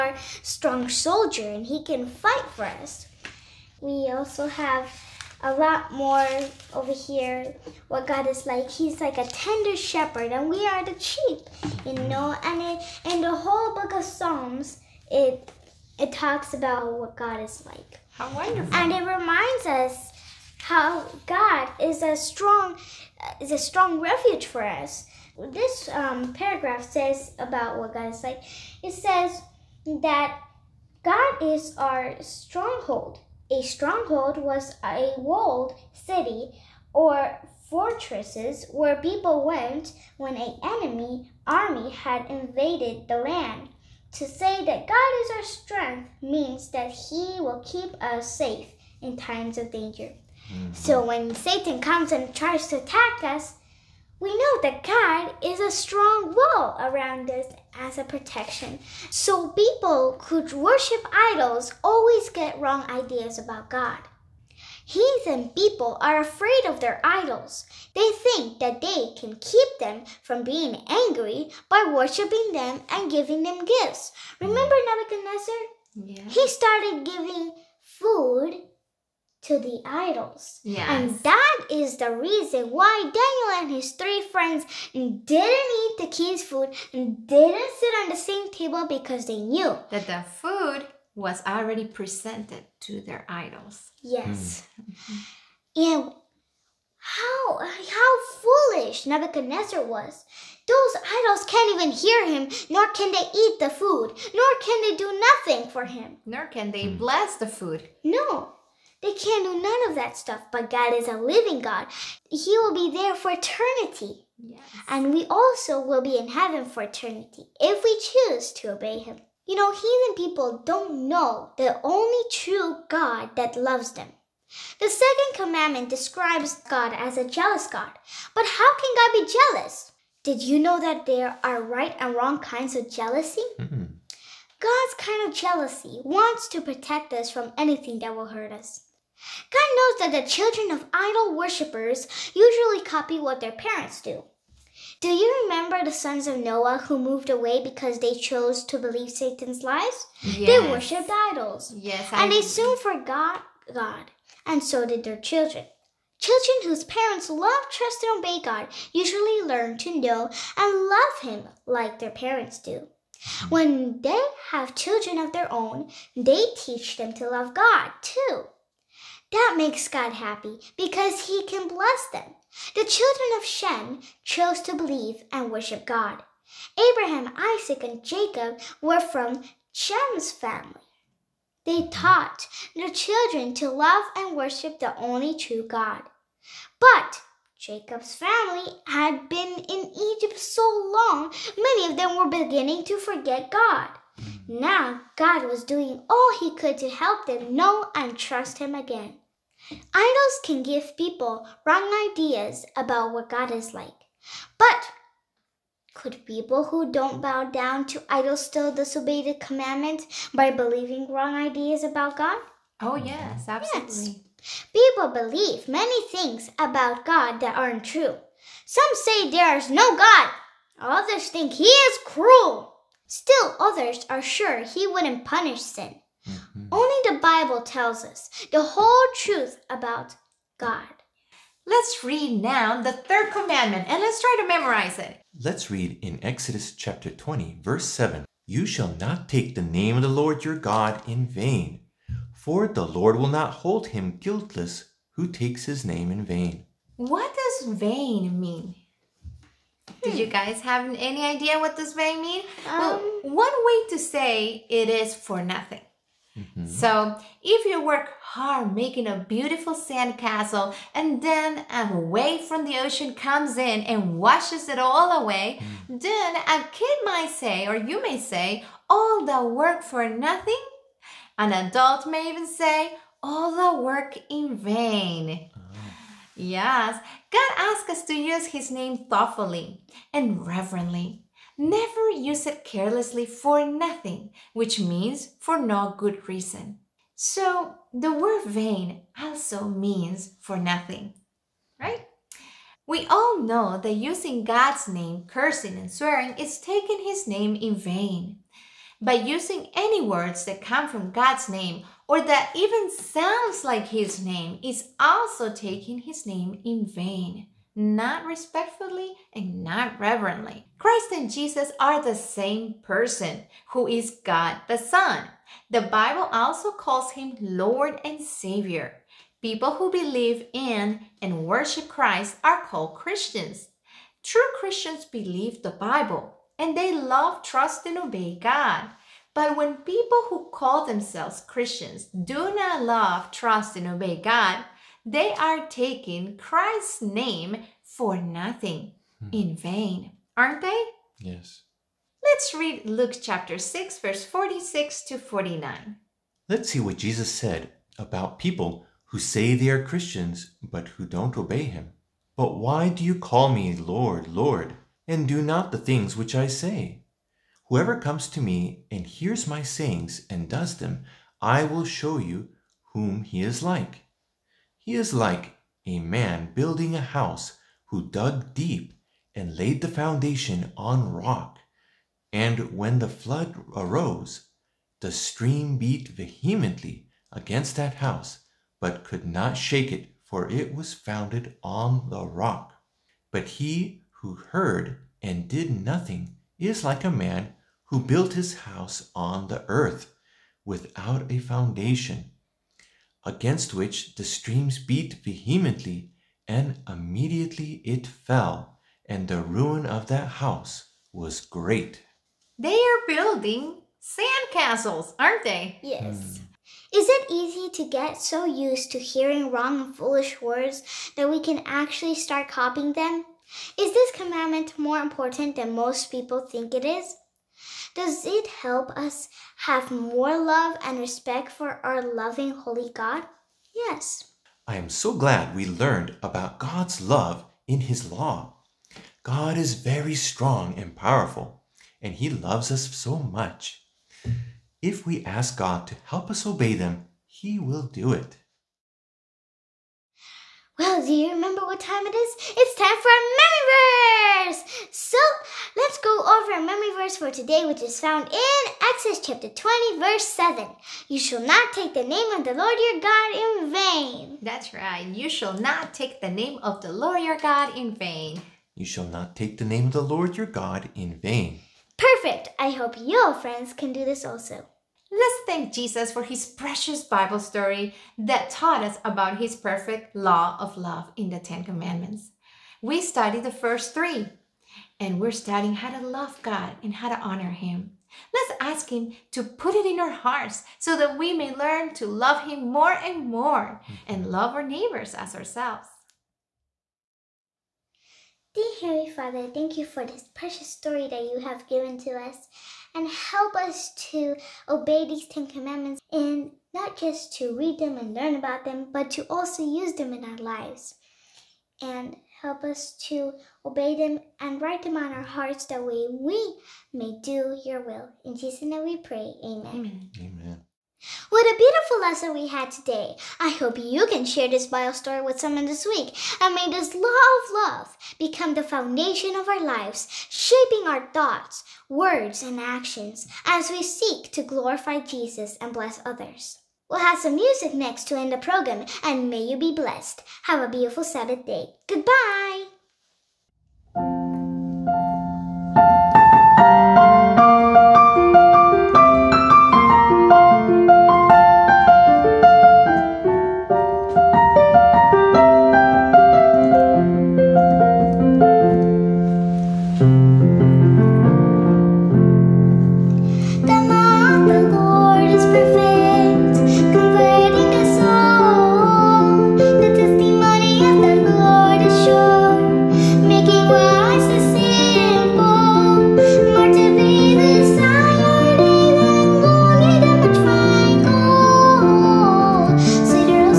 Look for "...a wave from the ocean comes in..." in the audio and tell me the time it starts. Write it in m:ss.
4:21.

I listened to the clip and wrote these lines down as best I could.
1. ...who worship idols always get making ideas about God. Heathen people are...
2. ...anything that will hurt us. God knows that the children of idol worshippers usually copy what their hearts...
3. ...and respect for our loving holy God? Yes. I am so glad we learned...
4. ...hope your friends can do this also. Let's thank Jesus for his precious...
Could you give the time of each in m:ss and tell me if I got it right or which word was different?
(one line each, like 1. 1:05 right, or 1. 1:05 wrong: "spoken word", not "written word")
1. 1:00 wrong: "wrong", not "making"
2. 2:17 wrong: "parents", not "hearts"
3. 7:00 right
4. 7:42 right.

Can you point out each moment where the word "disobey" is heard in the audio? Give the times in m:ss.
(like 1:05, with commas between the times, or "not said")
3:28.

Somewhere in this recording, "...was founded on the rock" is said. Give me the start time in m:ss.
6:20.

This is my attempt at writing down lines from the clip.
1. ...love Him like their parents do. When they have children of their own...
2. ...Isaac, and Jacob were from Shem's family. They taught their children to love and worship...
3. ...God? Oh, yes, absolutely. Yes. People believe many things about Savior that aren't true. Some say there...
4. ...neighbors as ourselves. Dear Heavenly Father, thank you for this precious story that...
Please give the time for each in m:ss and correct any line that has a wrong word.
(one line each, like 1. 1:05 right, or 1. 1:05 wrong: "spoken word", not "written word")
1. 2:40 right
2. 2:57 right
3. 3:32 wrong: "God", not "Savior"
4. 8:04 right.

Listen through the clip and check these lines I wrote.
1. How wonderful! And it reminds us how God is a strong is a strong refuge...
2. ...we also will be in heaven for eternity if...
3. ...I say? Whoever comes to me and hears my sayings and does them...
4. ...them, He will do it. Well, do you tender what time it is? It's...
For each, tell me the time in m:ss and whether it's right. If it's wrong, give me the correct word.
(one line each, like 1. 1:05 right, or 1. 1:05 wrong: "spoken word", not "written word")
1. 0:18 right
2. 1:55 right
3. 5:56 right
4. 7:16 wrong: "remember", not "tender".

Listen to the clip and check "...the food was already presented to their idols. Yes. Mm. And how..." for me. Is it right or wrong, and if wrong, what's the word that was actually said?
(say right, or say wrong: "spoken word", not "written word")
right.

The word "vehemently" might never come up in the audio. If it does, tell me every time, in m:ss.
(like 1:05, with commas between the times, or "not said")
6:16, 6:35.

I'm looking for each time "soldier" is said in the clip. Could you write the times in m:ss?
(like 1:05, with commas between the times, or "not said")
0:00.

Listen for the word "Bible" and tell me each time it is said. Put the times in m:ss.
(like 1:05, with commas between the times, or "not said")
3:47, 5:15, 5:25, 7:47, 8:34.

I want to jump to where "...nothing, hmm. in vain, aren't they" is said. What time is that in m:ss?
5:38.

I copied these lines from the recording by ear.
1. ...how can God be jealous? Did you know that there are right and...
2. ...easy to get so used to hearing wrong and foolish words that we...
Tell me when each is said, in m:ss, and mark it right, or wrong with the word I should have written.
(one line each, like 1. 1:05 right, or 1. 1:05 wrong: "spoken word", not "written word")
1. 2:08 right
2. 6:47 right.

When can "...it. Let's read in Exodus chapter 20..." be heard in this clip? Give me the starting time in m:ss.
3:54.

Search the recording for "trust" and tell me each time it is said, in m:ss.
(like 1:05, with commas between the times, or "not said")
2:37, 3:18, 5:27, 5:33.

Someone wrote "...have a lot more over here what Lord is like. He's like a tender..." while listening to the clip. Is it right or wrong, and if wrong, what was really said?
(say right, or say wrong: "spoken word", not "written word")
wrong: "God", not "Lord".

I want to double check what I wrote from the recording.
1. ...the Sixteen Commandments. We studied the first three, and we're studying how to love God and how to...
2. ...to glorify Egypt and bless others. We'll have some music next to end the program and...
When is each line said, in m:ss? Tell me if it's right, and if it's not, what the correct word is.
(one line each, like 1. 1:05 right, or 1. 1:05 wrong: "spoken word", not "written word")
1. 7:51 wrong: "Ten", not "Sixteen"
2. 8:44 wrong: "Jesus", not "Egypt".